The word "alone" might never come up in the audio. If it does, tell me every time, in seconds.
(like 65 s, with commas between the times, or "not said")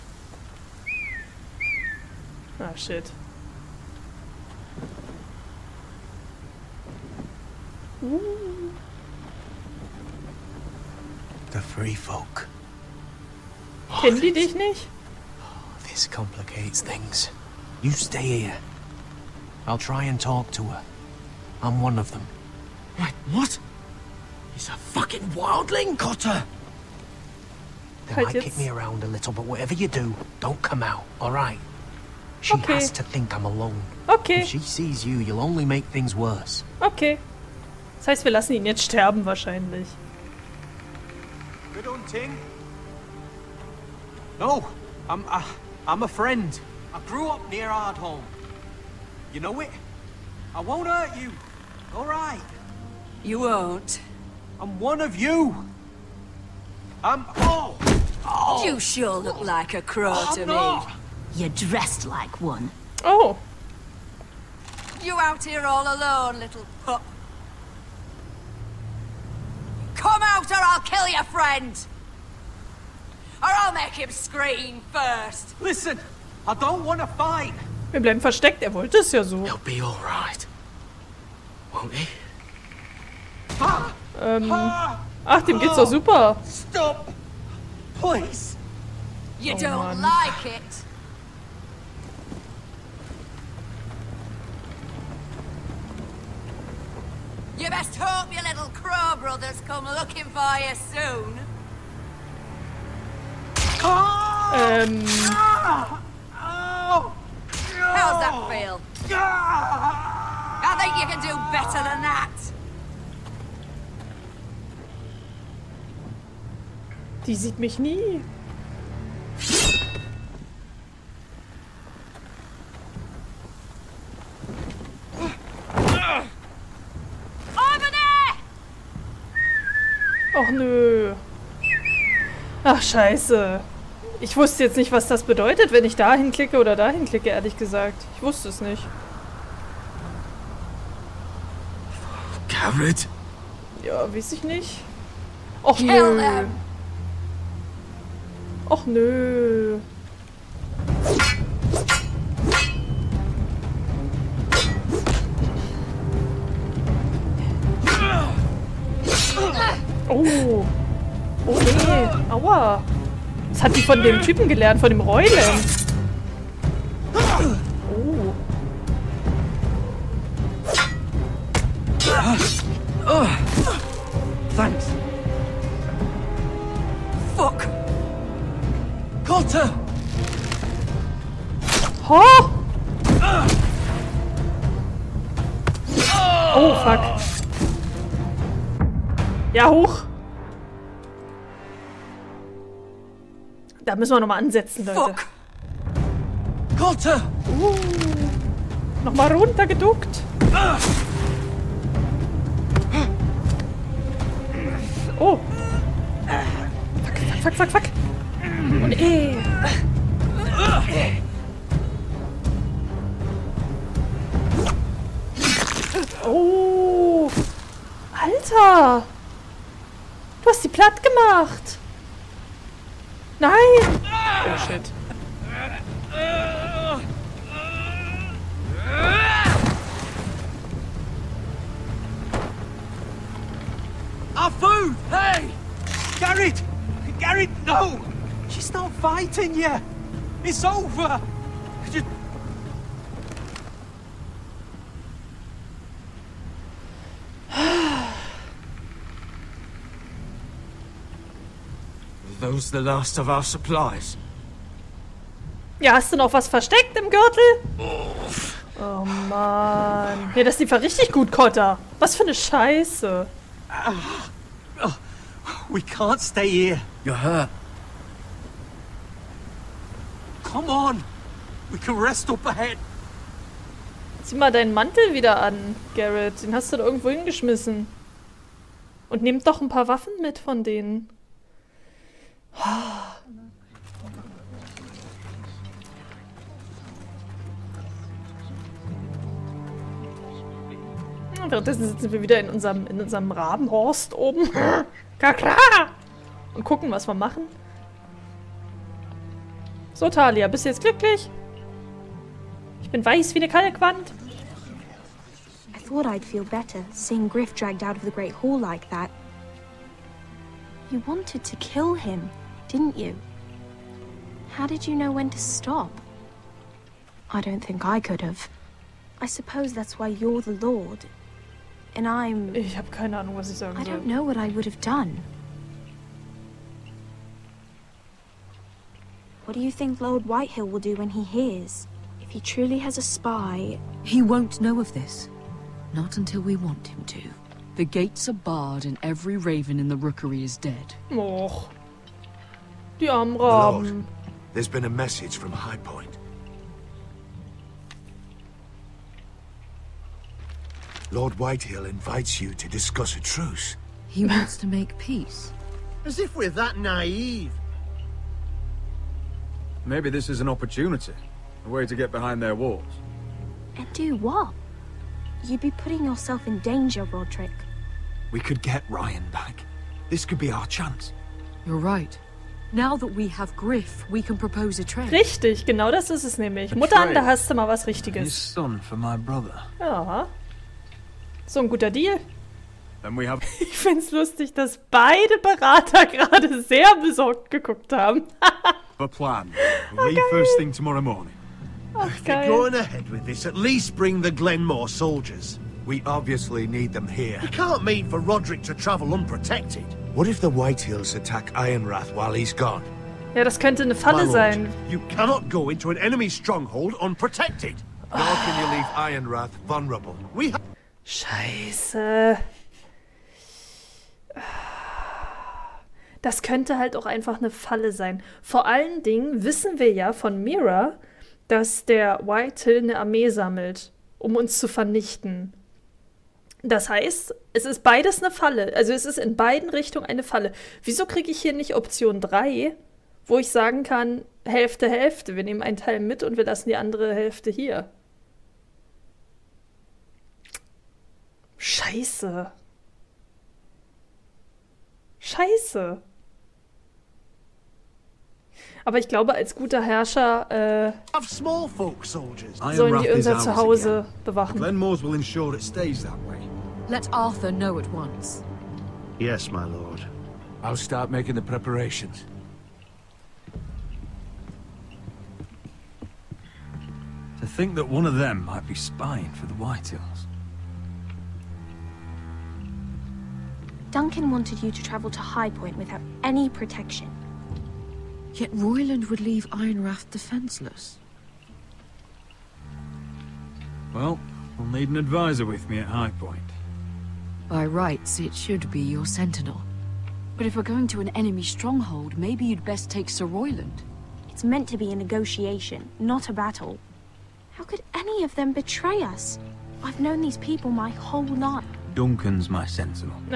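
33 s, 65 s.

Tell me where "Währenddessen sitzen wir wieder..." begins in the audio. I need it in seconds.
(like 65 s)
291 s.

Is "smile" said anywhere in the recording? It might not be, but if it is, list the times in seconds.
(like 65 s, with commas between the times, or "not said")
not said.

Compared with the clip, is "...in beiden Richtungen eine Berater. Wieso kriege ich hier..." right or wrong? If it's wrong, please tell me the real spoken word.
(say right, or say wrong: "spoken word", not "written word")
wrong: "Falle", not "Berater".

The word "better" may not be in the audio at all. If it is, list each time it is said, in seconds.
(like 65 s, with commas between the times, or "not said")
111 s, 306 s.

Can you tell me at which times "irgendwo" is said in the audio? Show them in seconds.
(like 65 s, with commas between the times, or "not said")
276 s.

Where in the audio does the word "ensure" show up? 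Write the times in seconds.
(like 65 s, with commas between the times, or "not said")
455 s.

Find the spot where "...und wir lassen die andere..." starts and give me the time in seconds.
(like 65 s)
436 s.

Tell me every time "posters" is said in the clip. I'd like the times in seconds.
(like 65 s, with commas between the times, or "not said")
not said.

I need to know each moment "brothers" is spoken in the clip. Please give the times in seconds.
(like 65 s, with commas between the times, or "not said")
99 s, 379 s.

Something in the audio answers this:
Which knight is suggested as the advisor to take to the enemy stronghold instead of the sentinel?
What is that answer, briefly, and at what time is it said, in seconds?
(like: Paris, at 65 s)
Sir Royland, at 493 s.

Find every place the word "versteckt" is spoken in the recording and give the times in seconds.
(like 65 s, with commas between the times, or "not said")
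78 s, 256 s.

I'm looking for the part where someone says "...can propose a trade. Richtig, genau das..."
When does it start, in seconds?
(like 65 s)
374 s.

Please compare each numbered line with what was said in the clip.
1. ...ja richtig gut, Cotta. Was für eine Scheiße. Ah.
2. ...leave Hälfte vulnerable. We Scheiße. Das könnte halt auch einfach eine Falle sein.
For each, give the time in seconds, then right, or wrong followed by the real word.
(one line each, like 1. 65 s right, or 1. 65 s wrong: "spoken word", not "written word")
1. 260 s right
2. 408 s wrong: "Ironwrath", not "Hälfte".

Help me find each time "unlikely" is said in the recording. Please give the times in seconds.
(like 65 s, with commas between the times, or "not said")
not said.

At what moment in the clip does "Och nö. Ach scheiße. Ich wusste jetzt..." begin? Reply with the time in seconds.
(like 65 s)
130 s.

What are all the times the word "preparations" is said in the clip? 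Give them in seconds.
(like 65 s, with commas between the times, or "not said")
461 s.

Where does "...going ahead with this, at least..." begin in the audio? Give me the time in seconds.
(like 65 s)
392 s.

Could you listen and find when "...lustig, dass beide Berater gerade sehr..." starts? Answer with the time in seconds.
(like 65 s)
384 s.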